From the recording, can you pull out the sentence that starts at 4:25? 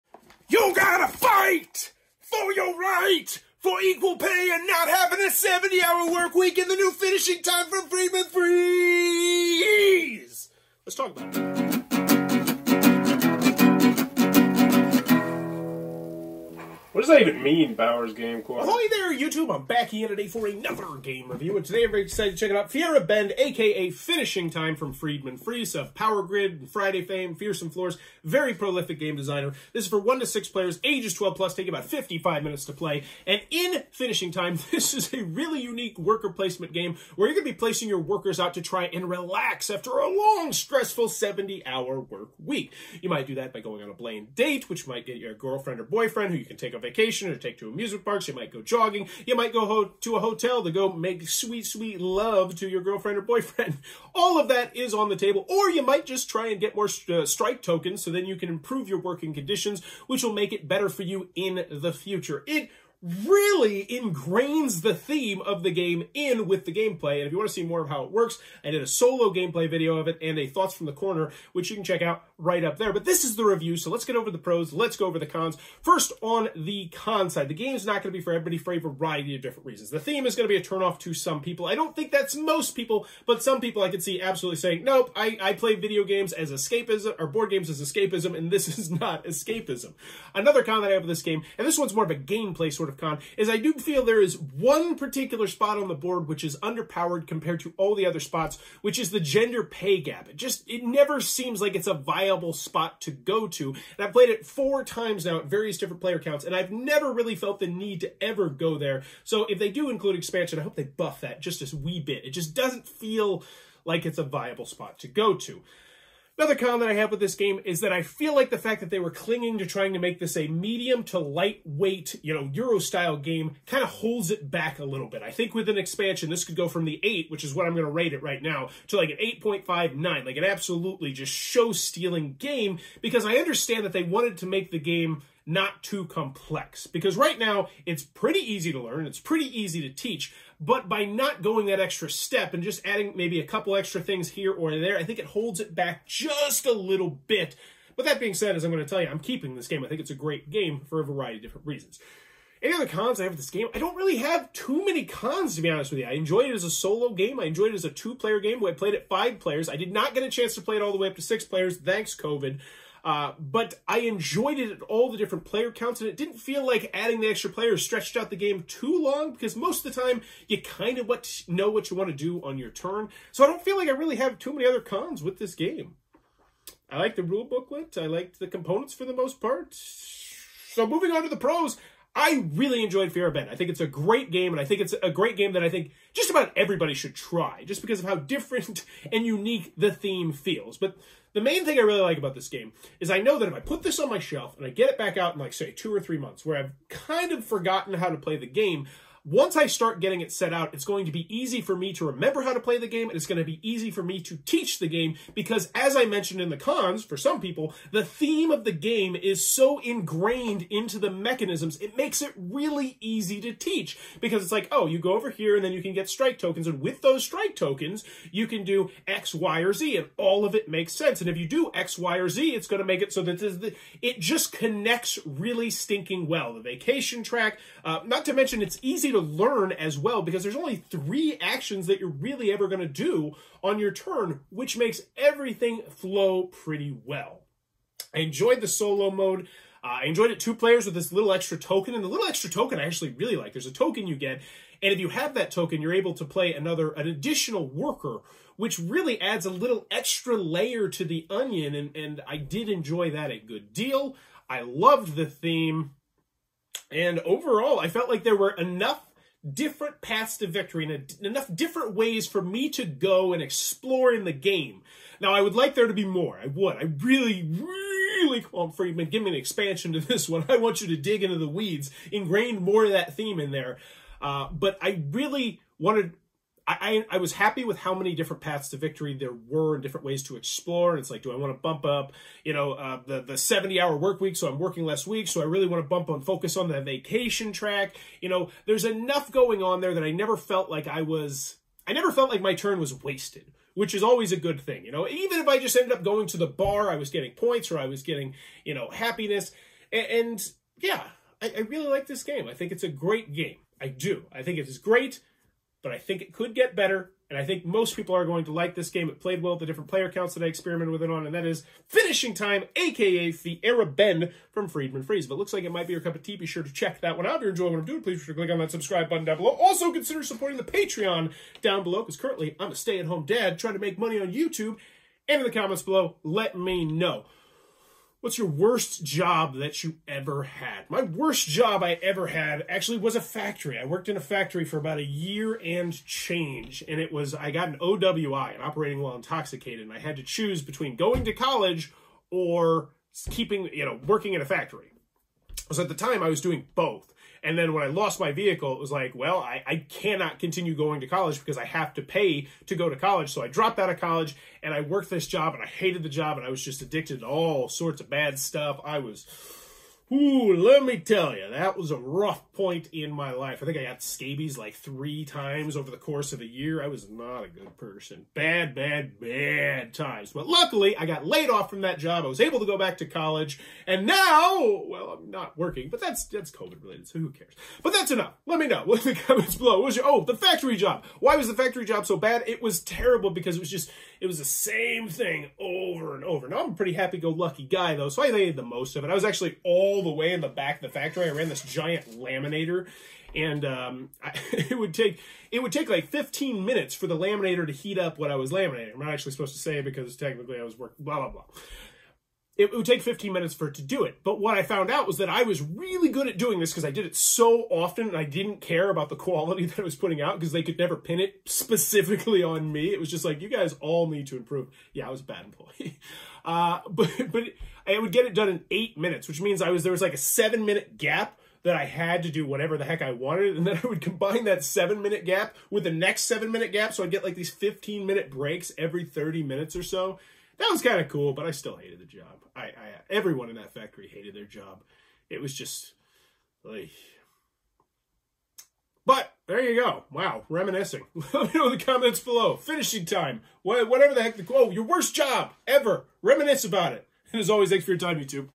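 Now, I would like there to be more.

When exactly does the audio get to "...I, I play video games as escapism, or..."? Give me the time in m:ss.
1:25.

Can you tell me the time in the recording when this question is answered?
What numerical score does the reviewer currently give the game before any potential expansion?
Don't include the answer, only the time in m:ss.
2:06.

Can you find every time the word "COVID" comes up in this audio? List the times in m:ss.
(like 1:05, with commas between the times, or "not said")
2:42, 6:16.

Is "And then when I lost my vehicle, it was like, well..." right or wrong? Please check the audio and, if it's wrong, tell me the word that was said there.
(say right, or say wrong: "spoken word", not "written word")
right.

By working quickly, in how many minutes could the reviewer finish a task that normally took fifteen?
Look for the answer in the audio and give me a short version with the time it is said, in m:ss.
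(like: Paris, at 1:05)
8, at 6:58.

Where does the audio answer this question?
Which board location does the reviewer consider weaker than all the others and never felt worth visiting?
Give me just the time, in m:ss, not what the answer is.
1:39.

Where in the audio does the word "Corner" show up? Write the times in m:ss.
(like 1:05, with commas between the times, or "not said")
0:18, 1:10.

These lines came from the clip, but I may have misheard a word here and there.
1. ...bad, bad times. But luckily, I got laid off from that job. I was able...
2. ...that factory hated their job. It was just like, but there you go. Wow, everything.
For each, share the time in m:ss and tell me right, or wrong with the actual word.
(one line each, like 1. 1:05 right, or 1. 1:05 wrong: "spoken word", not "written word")
1. 6:08 right
2. 7:13 wrong: "reminiscing", not "everything".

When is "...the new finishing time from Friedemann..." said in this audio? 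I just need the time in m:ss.
0:06.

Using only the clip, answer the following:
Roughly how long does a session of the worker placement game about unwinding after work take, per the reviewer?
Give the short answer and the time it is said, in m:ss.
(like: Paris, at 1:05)
55 minutes, at 0:31.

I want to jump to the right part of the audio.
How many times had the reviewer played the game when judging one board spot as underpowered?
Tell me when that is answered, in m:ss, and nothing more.
1:44.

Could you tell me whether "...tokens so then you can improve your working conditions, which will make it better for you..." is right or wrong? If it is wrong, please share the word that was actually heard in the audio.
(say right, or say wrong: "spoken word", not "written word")
right.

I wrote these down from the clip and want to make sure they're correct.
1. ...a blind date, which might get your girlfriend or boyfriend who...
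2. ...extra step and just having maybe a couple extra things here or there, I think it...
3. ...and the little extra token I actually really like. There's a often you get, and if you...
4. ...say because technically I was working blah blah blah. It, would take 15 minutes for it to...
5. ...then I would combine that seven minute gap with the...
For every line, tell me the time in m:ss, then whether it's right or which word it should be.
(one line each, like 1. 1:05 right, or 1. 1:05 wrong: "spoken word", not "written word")
1. 0:43 right
2. 2:21 wrong: "adding", not "having"
3. 4:01 wrong: "token", not "often"
4. 6:39 right
5. 7:03 right.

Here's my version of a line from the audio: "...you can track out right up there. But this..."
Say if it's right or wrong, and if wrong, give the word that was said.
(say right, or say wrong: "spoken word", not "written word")
wrong: "check", not "track".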